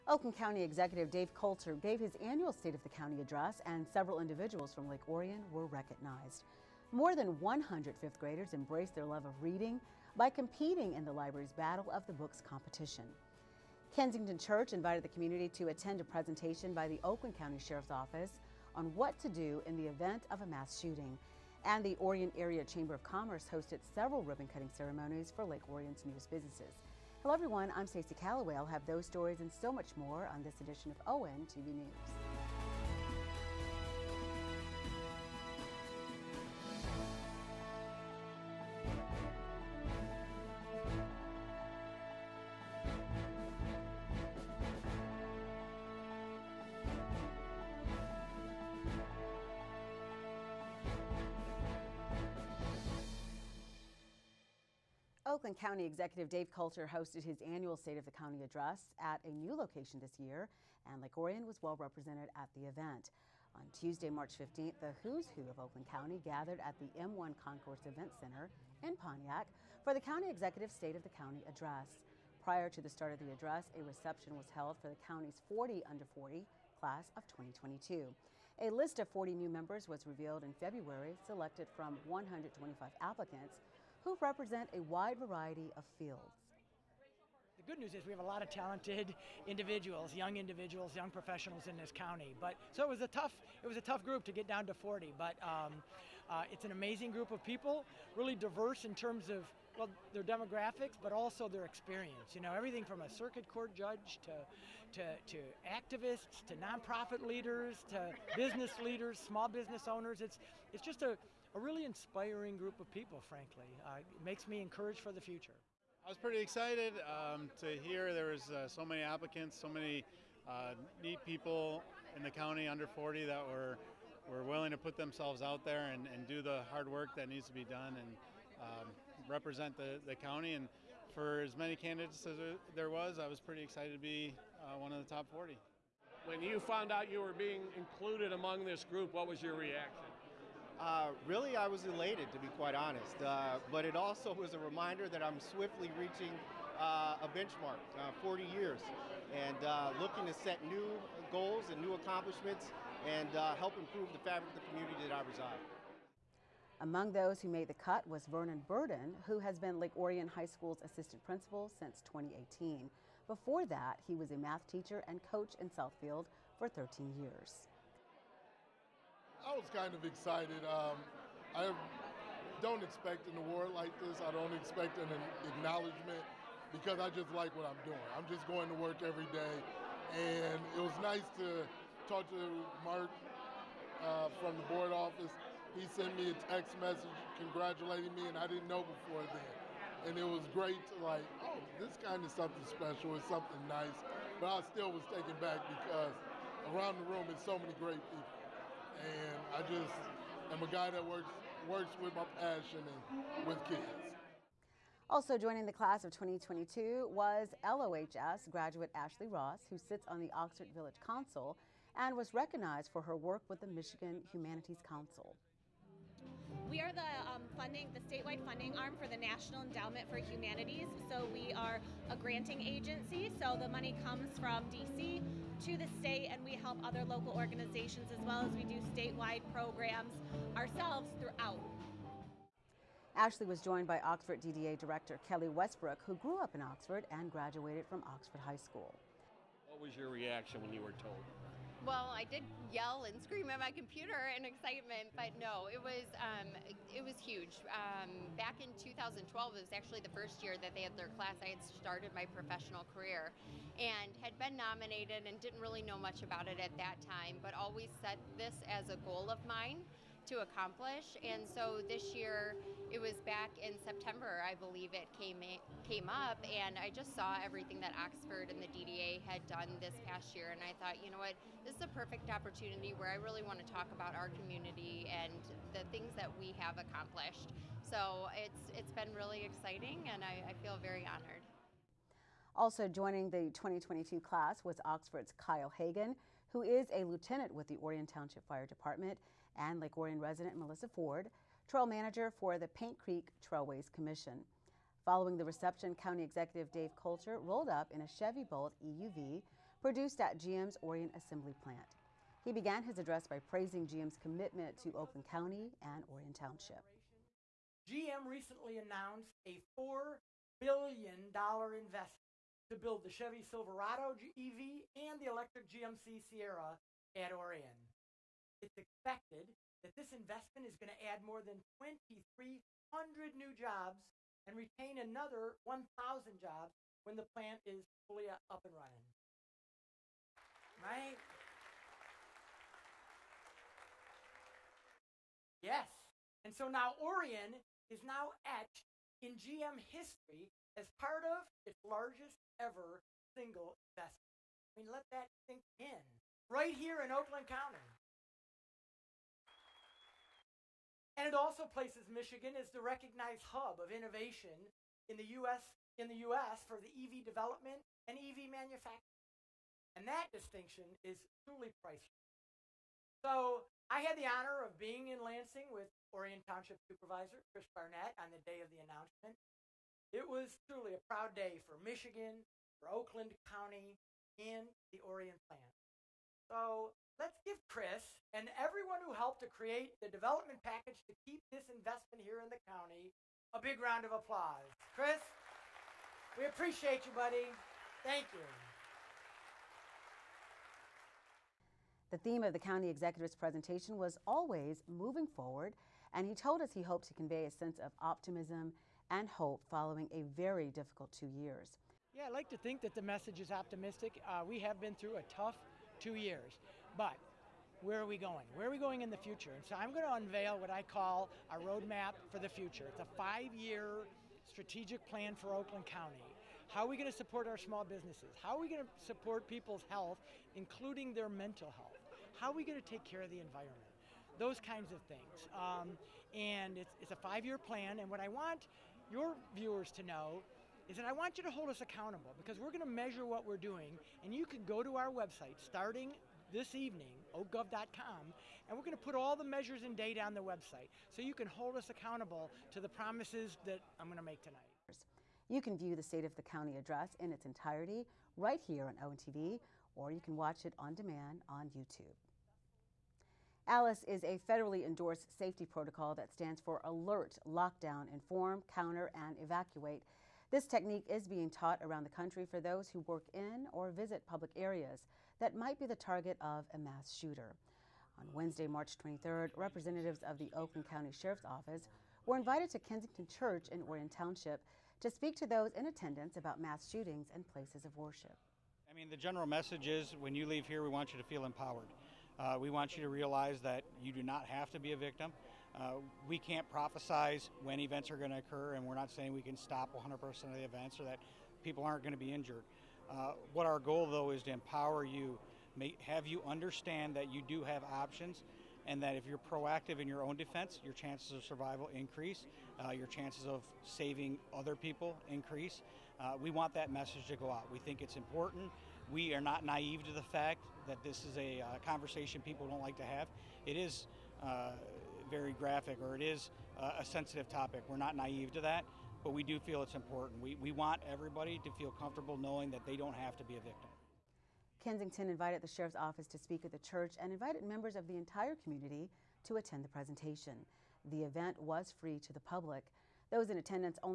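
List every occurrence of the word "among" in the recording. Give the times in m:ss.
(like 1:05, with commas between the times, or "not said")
2:18, 2:36.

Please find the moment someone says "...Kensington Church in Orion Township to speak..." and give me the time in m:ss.
7:52.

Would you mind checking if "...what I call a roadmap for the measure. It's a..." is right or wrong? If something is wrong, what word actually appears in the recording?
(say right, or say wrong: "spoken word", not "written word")
wrong: "future", not "measure".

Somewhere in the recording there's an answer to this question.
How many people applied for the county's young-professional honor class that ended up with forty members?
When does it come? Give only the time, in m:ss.
1:22.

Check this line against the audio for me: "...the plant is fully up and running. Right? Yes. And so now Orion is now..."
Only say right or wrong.
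right.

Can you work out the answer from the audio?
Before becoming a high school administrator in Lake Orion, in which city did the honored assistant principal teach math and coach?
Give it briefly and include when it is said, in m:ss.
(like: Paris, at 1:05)
Southfield, at 2:45.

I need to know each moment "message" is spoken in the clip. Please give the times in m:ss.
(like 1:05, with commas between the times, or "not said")
3:06, 6:43, 7:59, 8:26.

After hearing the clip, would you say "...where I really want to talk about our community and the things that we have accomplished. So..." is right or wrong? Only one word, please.
right.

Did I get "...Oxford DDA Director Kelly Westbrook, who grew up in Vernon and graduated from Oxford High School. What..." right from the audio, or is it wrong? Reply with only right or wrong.
wrong.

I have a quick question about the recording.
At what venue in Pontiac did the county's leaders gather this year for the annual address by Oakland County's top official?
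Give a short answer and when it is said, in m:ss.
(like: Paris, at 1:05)
M1 Concourse Event Center, at 1:06.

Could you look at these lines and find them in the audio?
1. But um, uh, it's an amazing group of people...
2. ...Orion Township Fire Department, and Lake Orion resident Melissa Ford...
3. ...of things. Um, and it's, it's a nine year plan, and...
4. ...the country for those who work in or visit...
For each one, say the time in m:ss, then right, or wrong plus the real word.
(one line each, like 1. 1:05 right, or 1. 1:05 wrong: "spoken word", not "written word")
1. 1:35 right
2. 4:47 right
3. 7:04 wrong: "five", not "nine"
4. 7:42 right.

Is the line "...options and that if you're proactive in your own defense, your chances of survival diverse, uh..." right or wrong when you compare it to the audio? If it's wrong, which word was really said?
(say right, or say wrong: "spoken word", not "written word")
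wrong: "increase", not "diverse".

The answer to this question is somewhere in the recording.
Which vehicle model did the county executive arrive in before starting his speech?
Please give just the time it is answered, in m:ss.
4:58.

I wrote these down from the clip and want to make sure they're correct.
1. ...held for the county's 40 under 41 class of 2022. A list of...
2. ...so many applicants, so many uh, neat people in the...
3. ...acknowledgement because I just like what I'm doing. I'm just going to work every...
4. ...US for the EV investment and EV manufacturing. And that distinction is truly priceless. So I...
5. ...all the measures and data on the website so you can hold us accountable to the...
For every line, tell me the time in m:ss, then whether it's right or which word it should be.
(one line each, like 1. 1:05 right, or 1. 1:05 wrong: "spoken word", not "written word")
1. 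1:14 wrong: "40", not "41"
2. 1:58 right
3. 2:55 right
4. 5:56 wrong: "development", not "investment"
5. 7:19 right.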